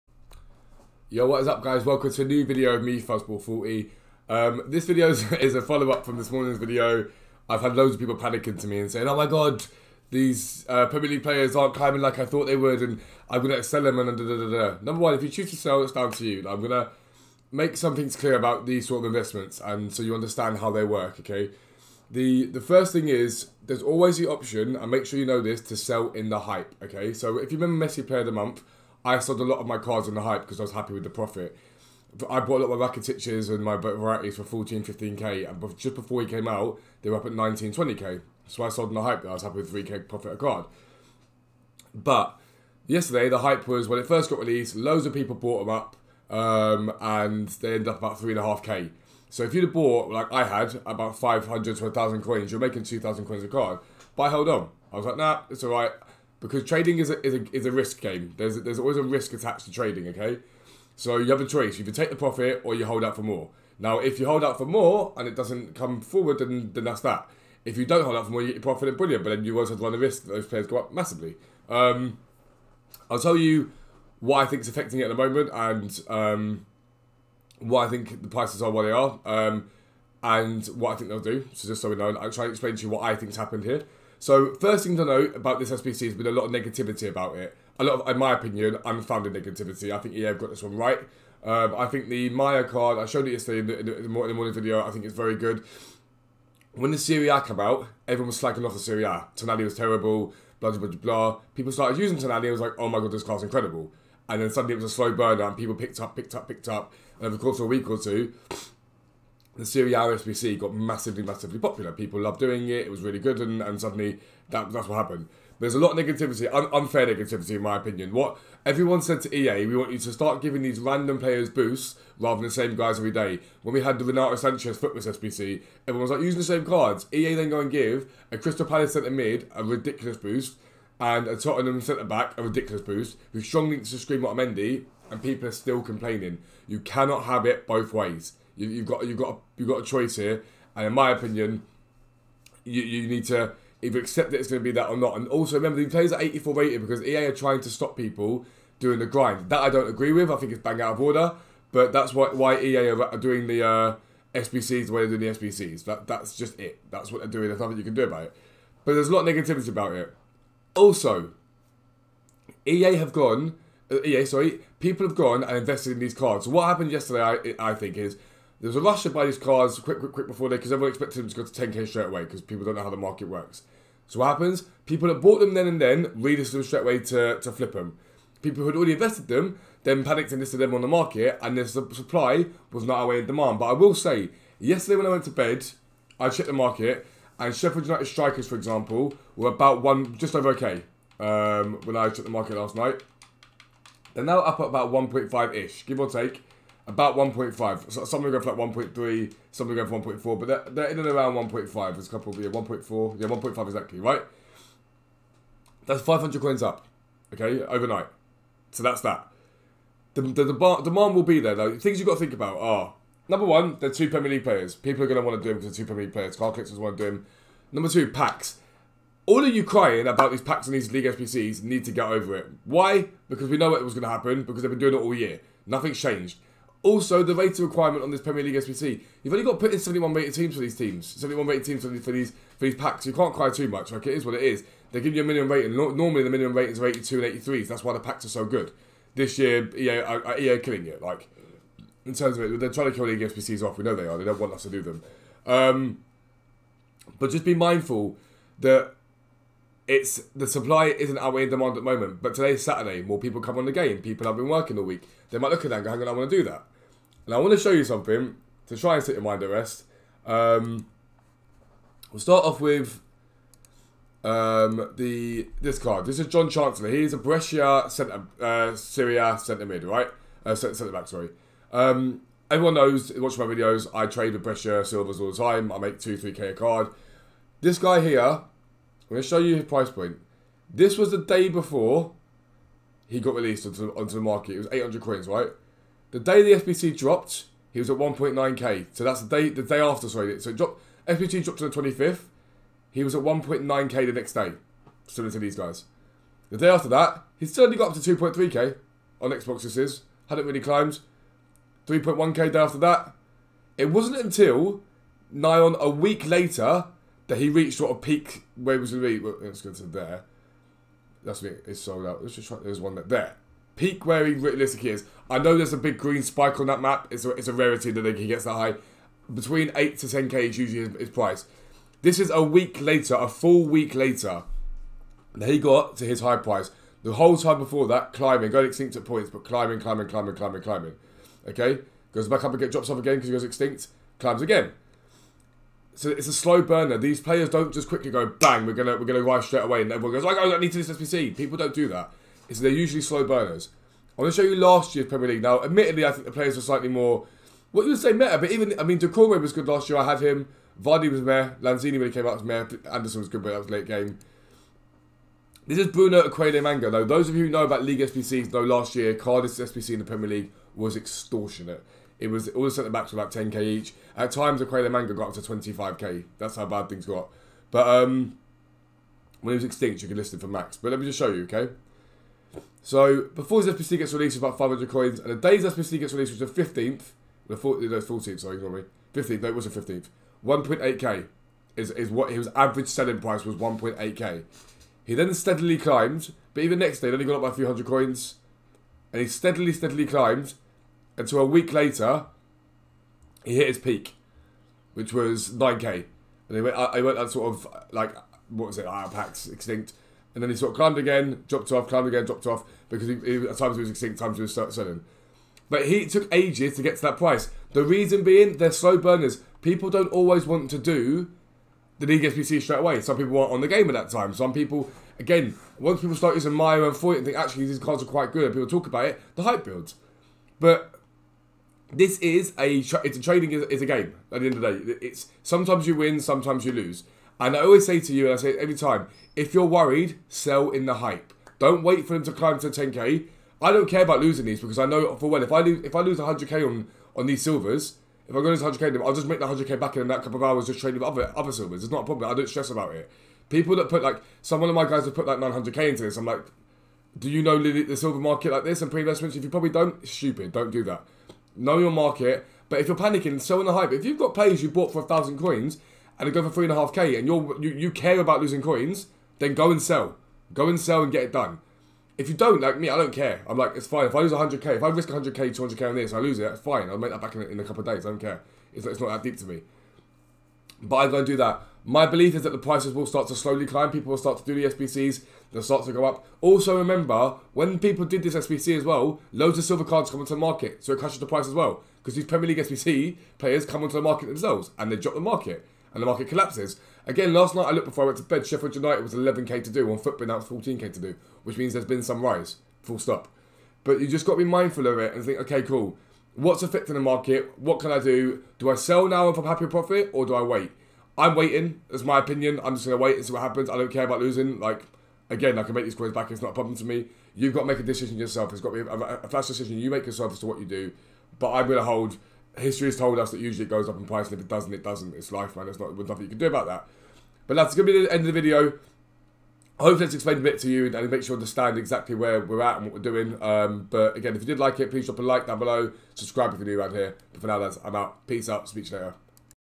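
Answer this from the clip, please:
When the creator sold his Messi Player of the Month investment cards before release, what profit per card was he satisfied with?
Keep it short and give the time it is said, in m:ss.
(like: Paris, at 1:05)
3k, at 0:39.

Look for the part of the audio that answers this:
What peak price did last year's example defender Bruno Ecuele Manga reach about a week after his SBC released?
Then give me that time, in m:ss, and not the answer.
6:35.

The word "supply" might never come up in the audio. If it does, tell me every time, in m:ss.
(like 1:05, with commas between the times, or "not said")
3:01, 4:10.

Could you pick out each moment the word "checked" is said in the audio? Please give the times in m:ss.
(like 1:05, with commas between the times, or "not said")
3:06, 3:12.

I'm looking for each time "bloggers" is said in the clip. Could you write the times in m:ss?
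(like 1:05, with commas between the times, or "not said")
not said.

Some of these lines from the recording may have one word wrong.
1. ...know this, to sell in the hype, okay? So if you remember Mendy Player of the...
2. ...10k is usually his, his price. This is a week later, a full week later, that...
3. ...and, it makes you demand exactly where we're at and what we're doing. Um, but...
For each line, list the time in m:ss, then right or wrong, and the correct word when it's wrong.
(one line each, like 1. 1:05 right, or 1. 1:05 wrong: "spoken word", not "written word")
1. 0:25 wrong: "Messi", not "Mendy"
2. 5:20 right
3. 8:40 wrong: "understand", not "demand".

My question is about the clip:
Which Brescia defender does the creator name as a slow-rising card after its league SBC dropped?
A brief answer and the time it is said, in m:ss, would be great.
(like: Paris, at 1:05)
Jhon Chancellor, at 4:26.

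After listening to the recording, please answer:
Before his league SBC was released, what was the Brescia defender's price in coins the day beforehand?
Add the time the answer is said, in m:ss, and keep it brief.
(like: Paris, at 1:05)
800 coins, at 4:44.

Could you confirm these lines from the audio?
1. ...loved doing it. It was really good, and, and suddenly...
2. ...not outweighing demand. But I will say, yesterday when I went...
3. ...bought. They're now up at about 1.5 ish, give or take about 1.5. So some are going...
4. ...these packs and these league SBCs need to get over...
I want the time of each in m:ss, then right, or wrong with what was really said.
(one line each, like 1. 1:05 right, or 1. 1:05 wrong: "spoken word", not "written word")
1. 1:52 right
2. 3:02 right
3. 3:12 wrong: "night", not "bought"
4. 3:40 right.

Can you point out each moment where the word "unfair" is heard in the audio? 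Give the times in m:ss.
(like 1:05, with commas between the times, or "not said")
1:56.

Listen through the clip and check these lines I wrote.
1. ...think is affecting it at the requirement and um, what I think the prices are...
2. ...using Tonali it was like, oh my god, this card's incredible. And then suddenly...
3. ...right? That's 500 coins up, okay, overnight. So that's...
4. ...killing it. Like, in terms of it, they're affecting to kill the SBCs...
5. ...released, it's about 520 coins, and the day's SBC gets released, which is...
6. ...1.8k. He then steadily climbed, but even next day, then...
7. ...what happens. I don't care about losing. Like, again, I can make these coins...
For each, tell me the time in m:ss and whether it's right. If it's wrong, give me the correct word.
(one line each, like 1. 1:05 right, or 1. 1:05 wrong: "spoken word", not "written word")
1. 1:14 wrong: "moment", not "requirement"
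2. 1:41 right
3. 3:23 right
4. 4:00 wrong: "trying", not "affecting"
5. 6:14 wrong: "500", not "520"
6. 6:23 right
7. 8:23 right.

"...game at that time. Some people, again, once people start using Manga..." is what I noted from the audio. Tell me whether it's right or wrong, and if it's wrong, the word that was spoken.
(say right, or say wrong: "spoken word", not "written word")
wrong: "Meyer", not "Manga".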